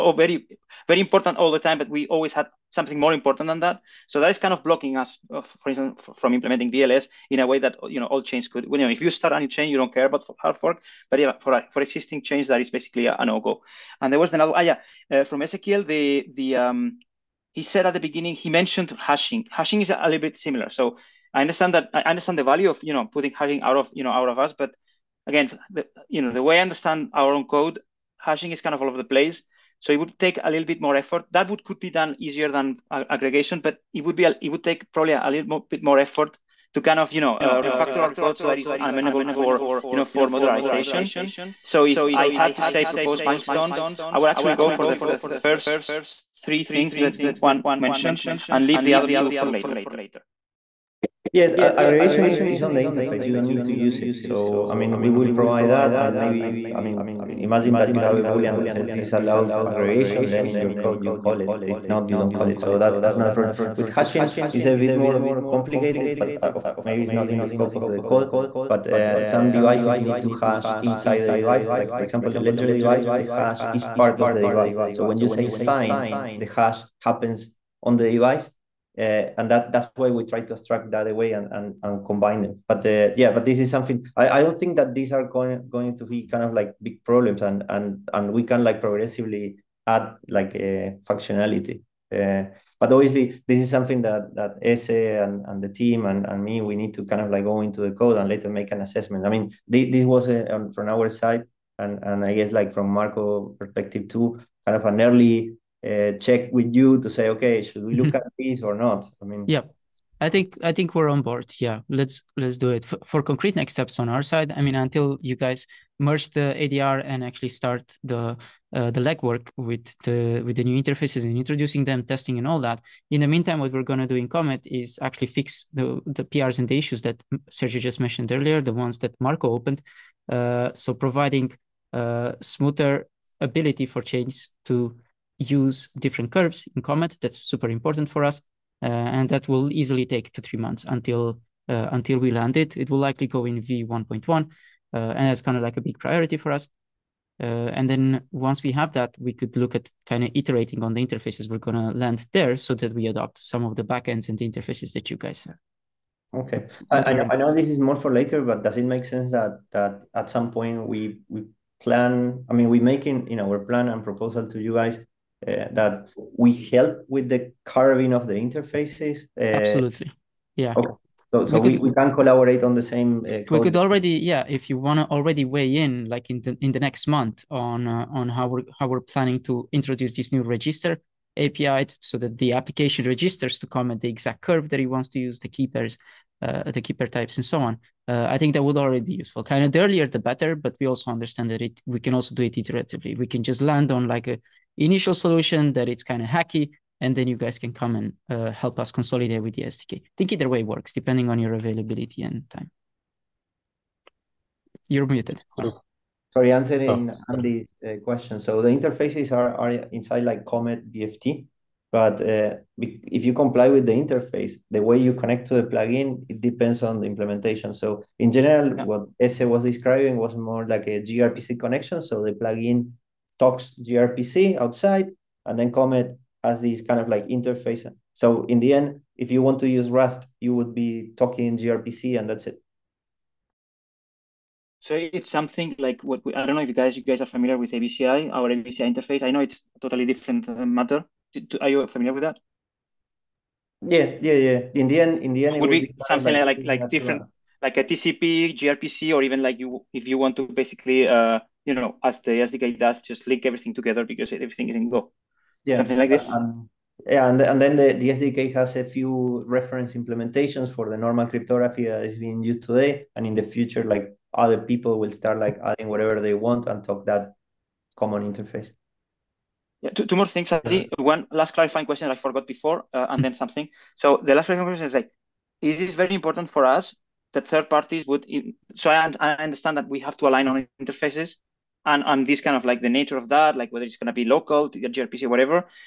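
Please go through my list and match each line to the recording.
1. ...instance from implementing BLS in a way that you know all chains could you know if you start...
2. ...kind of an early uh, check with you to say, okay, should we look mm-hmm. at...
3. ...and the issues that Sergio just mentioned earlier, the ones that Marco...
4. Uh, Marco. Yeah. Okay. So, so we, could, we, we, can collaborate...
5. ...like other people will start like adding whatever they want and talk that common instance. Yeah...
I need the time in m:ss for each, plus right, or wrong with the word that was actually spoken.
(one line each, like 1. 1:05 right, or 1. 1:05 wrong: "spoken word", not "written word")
1. 0:05 right
2. 1:44 right
3. 2:06 right
4. 2:49 wrong: "Absolutely", not "Marco"
5. 4:23 wrong: "interface", not "instance".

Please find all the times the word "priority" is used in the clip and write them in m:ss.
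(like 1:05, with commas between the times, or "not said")
2:25.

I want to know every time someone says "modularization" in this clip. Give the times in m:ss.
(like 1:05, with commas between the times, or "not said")
0:40.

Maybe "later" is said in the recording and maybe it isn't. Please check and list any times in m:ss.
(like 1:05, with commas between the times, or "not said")
0:49, 1:38, 2:38.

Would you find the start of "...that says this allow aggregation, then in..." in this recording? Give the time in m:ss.
0:58.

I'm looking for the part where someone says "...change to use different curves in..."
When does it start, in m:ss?
2:14.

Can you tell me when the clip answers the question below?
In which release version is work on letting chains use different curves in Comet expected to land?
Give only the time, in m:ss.
2:23.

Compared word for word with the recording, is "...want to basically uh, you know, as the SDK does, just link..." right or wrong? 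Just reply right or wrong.
right.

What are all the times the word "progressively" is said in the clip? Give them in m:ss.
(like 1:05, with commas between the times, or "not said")
1:28.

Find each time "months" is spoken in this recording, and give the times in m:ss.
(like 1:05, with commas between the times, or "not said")
2:20, 2:57.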